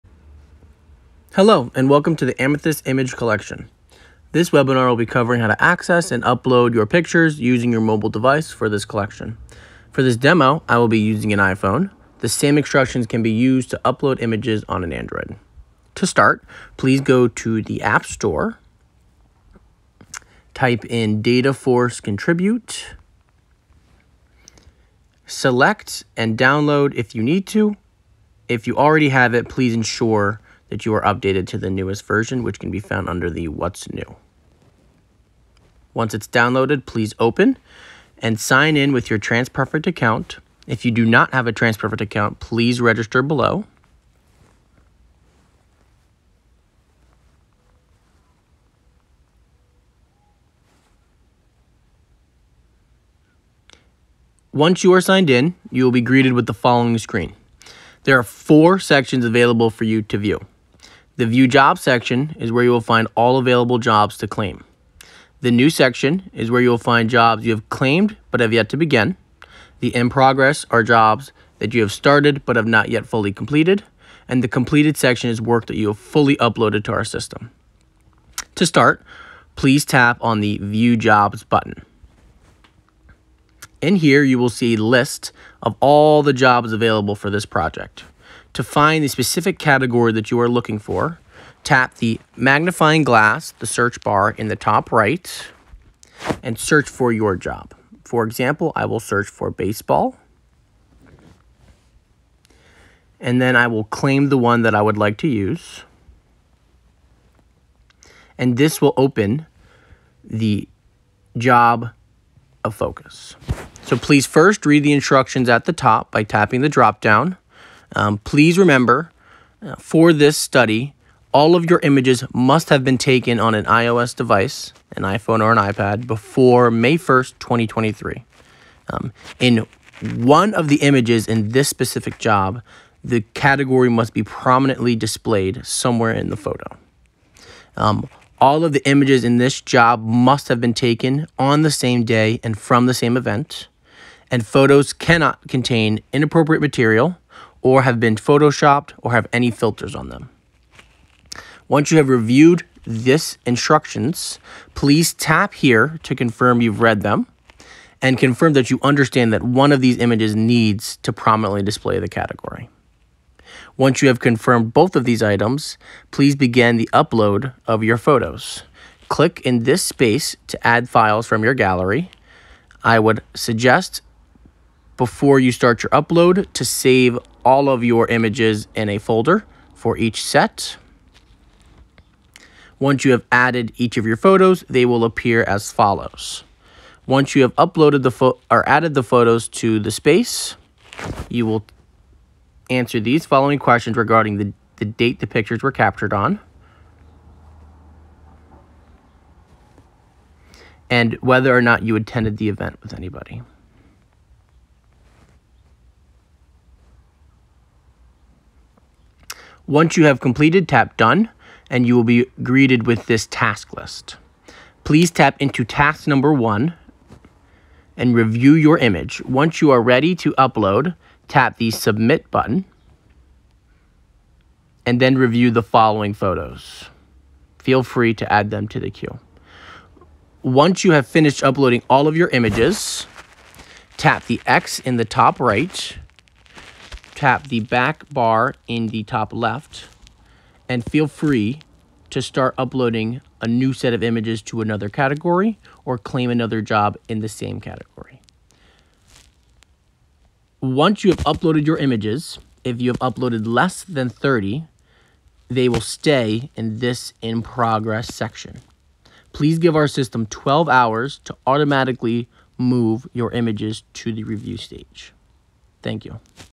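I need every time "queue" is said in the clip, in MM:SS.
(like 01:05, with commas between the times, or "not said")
03:48.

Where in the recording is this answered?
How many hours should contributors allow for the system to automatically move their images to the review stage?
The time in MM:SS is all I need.
04:20.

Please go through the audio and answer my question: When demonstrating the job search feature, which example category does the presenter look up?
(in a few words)
baseball.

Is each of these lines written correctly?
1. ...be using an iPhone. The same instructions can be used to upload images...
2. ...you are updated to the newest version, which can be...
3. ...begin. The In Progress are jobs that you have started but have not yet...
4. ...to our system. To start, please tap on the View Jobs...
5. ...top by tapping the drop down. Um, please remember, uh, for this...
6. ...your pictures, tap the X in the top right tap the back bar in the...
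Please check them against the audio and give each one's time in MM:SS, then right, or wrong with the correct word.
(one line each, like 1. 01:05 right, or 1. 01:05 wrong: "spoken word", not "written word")
1. 00:10 right
2. 00:30 right
3. 01:08 right
4. 01:16 right
5. 01:55 right
6. 03:52 wrong: "images", not "pictures".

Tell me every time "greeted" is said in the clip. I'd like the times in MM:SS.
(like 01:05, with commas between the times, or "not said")
00:56, 03:32.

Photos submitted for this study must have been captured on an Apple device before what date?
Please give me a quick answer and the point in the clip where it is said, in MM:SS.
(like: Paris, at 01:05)
May 1st, 2023, at 02:06.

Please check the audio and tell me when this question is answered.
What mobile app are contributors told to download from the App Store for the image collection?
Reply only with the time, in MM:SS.
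00:21.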